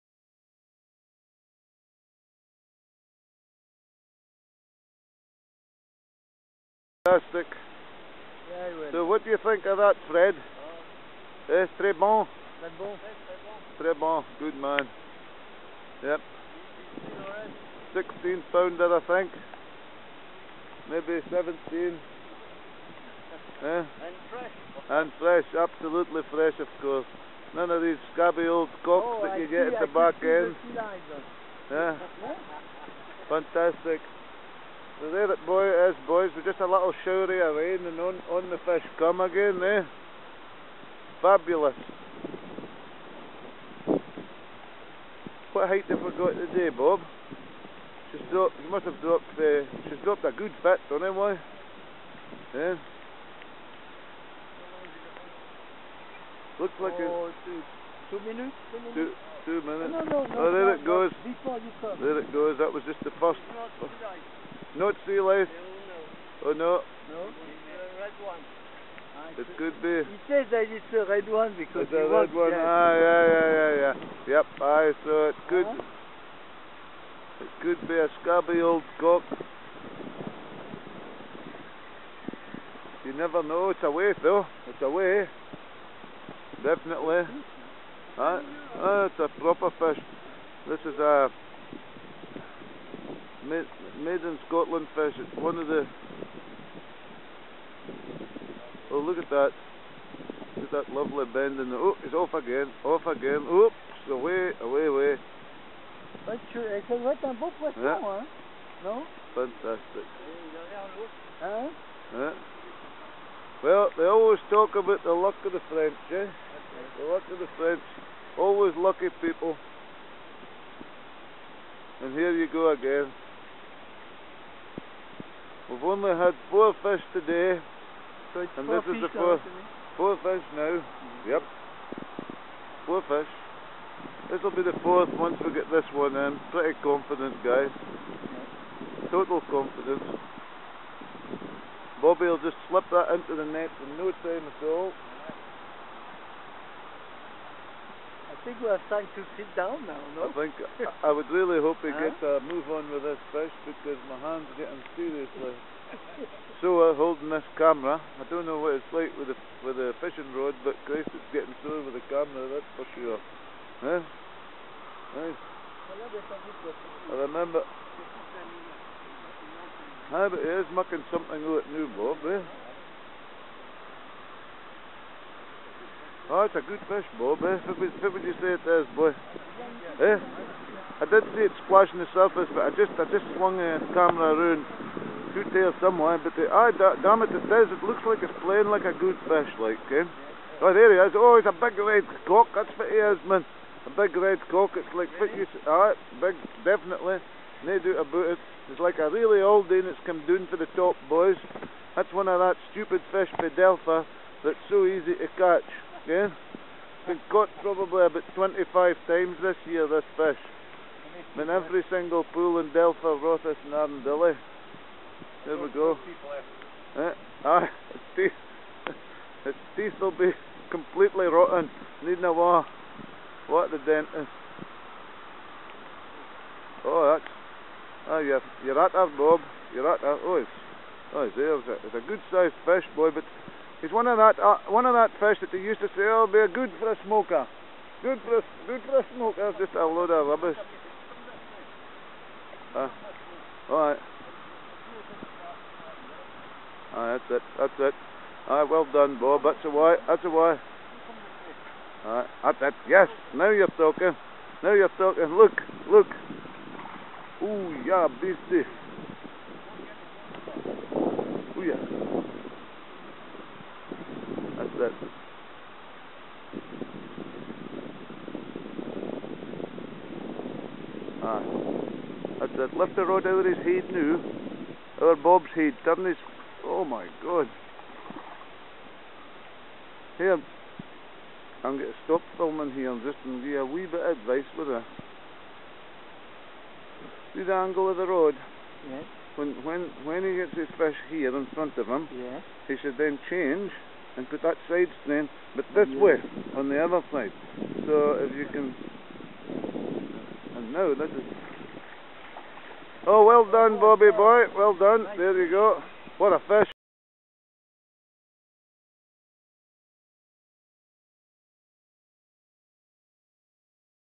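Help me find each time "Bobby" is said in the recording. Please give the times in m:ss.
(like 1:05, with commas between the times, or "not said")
2:22, 5:03.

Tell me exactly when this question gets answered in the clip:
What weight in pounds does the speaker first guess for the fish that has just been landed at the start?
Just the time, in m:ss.
0:17.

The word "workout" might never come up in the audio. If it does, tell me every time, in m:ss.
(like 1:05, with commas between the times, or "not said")
not said.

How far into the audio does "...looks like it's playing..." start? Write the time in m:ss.
3:07.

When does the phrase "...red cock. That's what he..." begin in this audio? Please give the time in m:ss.
3:11.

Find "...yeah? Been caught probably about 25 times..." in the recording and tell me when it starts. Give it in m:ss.
3:26.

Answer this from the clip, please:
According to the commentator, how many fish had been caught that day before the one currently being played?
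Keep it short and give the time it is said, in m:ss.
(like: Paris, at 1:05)
4, at 2:05.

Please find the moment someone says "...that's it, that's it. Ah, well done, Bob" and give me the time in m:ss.
4:07.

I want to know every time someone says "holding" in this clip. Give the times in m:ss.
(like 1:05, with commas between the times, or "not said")
2:36.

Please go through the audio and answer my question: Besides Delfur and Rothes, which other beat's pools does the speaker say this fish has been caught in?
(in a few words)
Arndilly.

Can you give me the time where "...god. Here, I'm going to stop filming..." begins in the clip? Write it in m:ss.
4:37.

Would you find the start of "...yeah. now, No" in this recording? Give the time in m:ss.
1:47.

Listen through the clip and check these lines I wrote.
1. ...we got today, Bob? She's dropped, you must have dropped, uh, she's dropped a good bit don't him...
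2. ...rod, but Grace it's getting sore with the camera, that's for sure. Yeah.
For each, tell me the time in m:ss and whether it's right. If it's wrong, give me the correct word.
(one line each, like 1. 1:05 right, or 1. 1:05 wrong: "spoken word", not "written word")
1. 0:46 right
2. 2:40 right.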